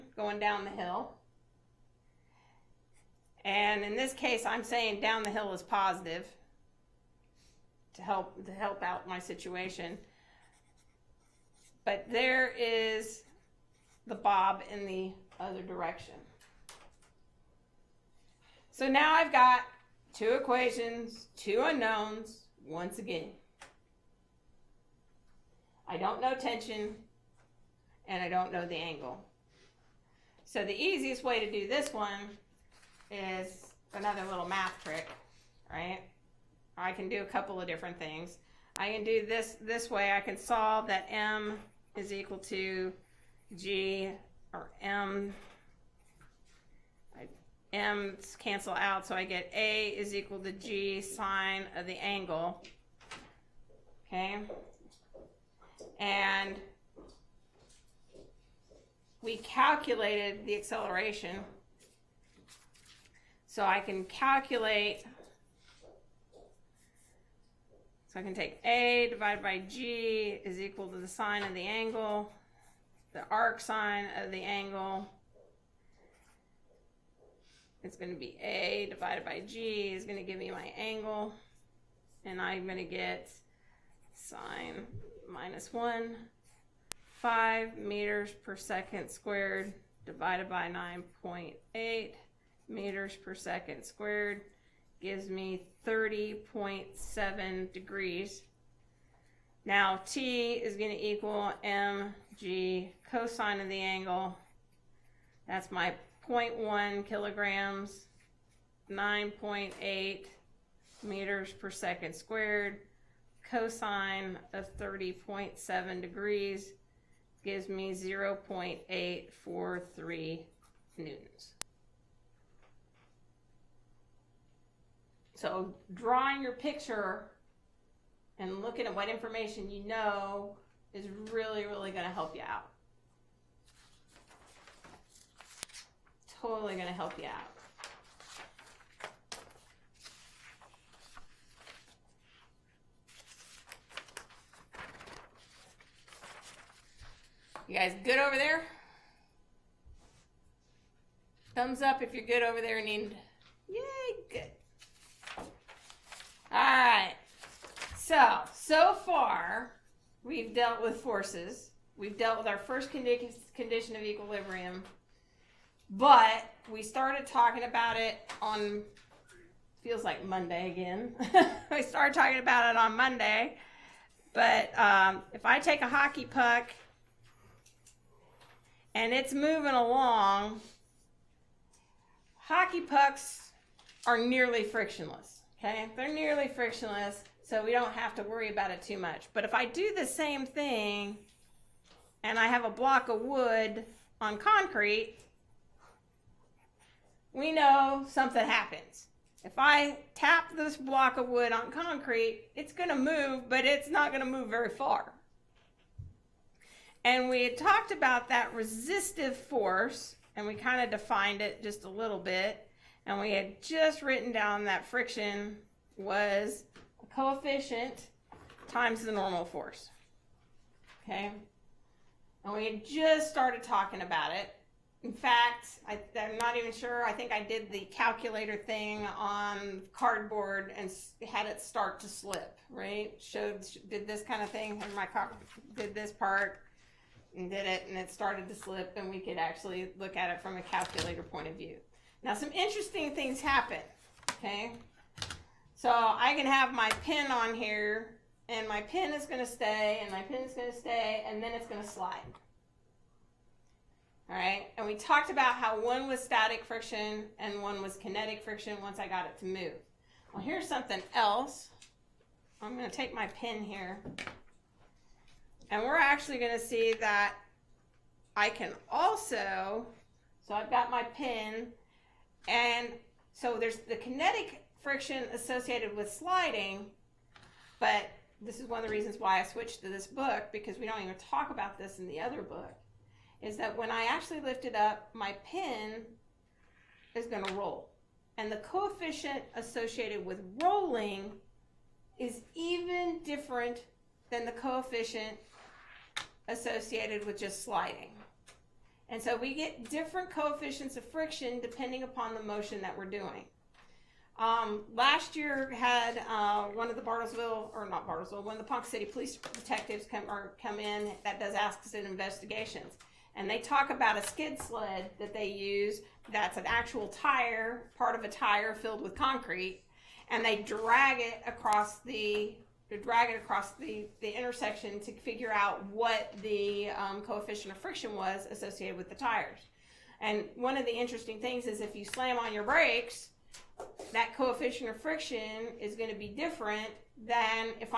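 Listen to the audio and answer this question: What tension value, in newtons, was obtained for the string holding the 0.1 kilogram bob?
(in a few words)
0.843 newtons.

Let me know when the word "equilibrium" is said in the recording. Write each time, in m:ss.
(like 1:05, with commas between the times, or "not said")
2:44.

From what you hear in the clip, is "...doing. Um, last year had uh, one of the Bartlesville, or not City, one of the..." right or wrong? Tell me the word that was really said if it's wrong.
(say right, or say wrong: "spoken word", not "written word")
wrong: "Bartlesville", not "City".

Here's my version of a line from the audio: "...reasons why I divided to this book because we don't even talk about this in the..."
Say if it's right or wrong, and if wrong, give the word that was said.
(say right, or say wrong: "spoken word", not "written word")
wrong: "switched", not "divided".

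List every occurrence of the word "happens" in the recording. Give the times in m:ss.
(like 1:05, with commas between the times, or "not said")
3:18, 4:03.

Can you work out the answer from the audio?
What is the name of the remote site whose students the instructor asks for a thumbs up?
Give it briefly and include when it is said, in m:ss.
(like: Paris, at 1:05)
Enid, at 2:32.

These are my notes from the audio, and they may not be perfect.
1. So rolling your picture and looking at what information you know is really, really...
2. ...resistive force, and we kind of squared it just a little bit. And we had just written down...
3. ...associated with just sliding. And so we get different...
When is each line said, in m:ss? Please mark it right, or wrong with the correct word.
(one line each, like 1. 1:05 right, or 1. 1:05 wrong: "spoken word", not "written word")
1. 2:05 wrong: "drawing", not "rolling"
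2. 3:28 wrong: "defined", not "squared"
3. 4:56 right.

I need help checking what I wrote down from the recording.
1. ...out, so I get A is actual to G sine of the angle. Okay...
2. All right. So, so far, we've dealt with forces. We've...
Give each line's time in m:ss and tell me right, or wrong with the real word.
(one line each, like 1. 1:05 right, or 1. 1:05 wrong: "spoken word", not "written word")
1. 0:48 wrong: "equal", not "actual"
2. 2:36 right.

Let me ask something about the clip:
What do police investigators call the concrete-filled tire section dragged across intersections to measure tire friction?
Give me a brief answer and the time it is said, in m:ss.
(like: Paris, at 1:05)
skid sled, at 5:14.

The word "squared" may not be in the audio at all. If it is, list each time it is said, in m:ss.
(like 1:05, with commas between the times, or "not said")
1:29, 1:33, 1:52.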